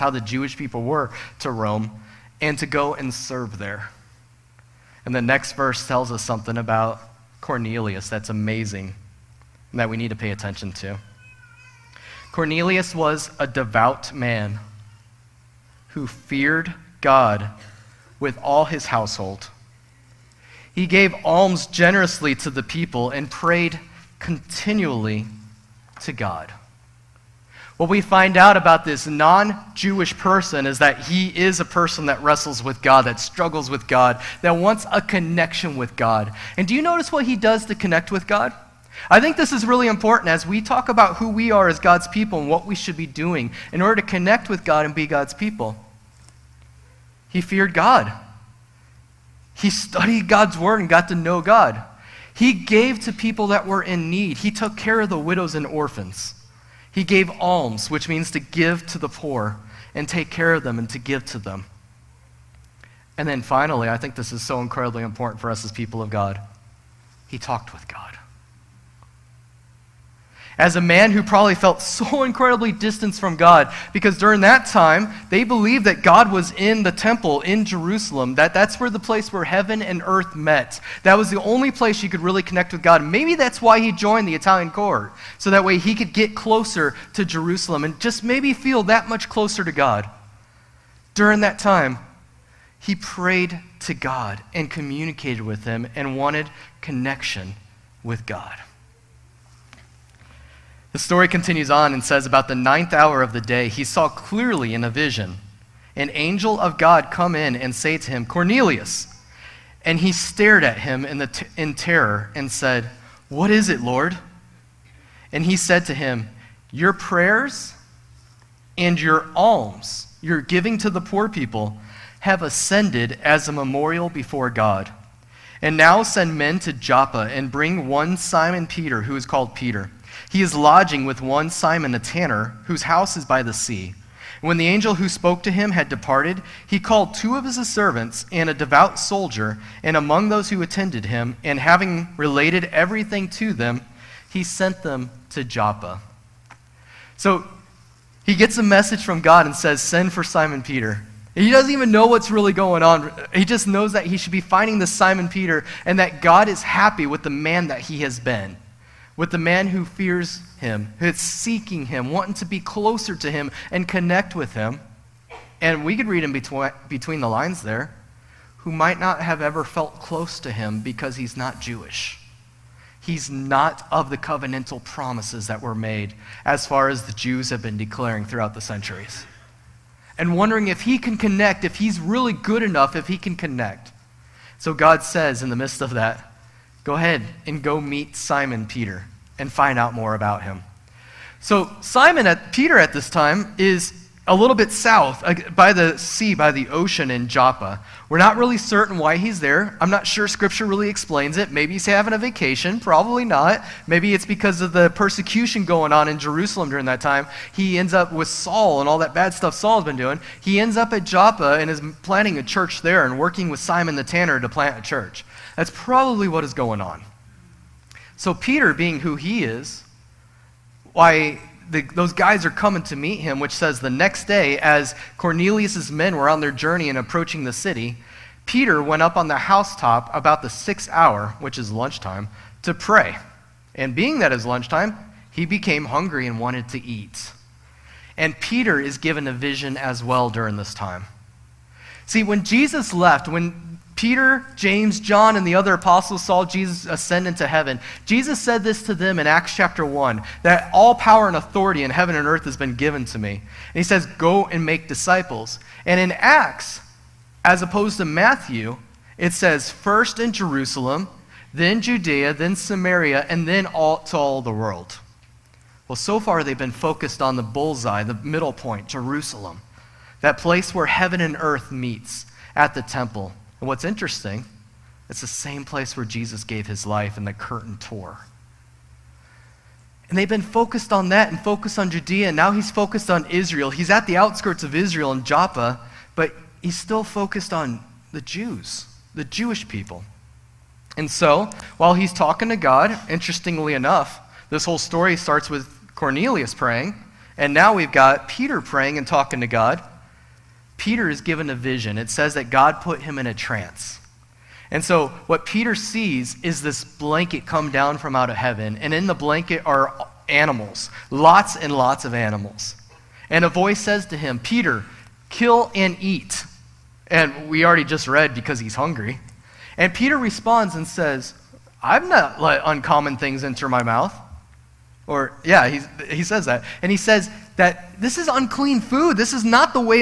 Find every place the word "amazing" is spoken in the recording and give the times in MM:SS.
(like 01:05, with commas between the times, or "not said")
00:08.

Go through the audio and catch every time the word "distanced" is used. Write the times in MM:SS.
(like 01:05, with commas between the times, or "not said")
01:12.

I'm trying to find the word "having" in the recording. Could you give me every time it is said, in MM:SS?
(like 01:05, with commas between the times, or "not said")
02:21, 03:21.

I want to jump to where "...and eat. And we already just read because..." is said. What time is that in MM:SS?
05:15.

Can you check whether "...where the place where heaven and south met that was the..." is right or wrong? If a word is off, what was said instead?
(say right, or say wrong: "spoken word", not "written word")
wrong: "earth", not "south".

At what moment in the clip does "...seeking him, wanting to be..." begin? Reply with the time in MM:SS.
02:41.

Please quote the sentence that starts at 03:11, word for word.
So, Simon at Peter at this time is a little bit south uh, by the sea, by the ocean in Joppa.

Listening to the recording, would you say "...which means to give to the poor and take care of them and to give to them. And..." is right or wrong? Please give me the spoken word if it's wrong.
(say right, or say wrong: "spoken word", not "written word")
right.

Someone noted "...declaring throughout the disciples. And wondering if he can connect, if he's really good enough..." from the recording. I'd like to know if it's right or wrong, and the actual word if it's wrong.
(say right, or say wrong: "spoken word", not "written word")
wrong: "centuries", not "disciples".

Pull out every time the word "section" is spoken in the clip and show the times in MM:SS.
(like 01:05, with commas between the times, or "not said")
not said.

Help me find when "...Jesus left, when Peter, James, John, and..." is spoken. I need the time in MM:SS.
04:02.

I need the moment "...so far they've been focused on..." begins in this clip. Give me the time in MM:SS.
04:25.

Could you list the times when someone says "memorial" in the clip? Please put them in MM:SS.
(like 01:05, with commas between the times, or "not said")
02:03.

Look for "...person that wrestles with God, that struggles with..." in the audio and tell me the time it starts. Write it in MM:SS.
00:31.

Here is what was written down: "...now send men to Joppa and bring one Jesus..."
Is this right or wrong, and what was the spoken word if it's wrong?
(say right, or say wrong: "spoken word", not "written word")
wrong: "Simon", not "Jesus".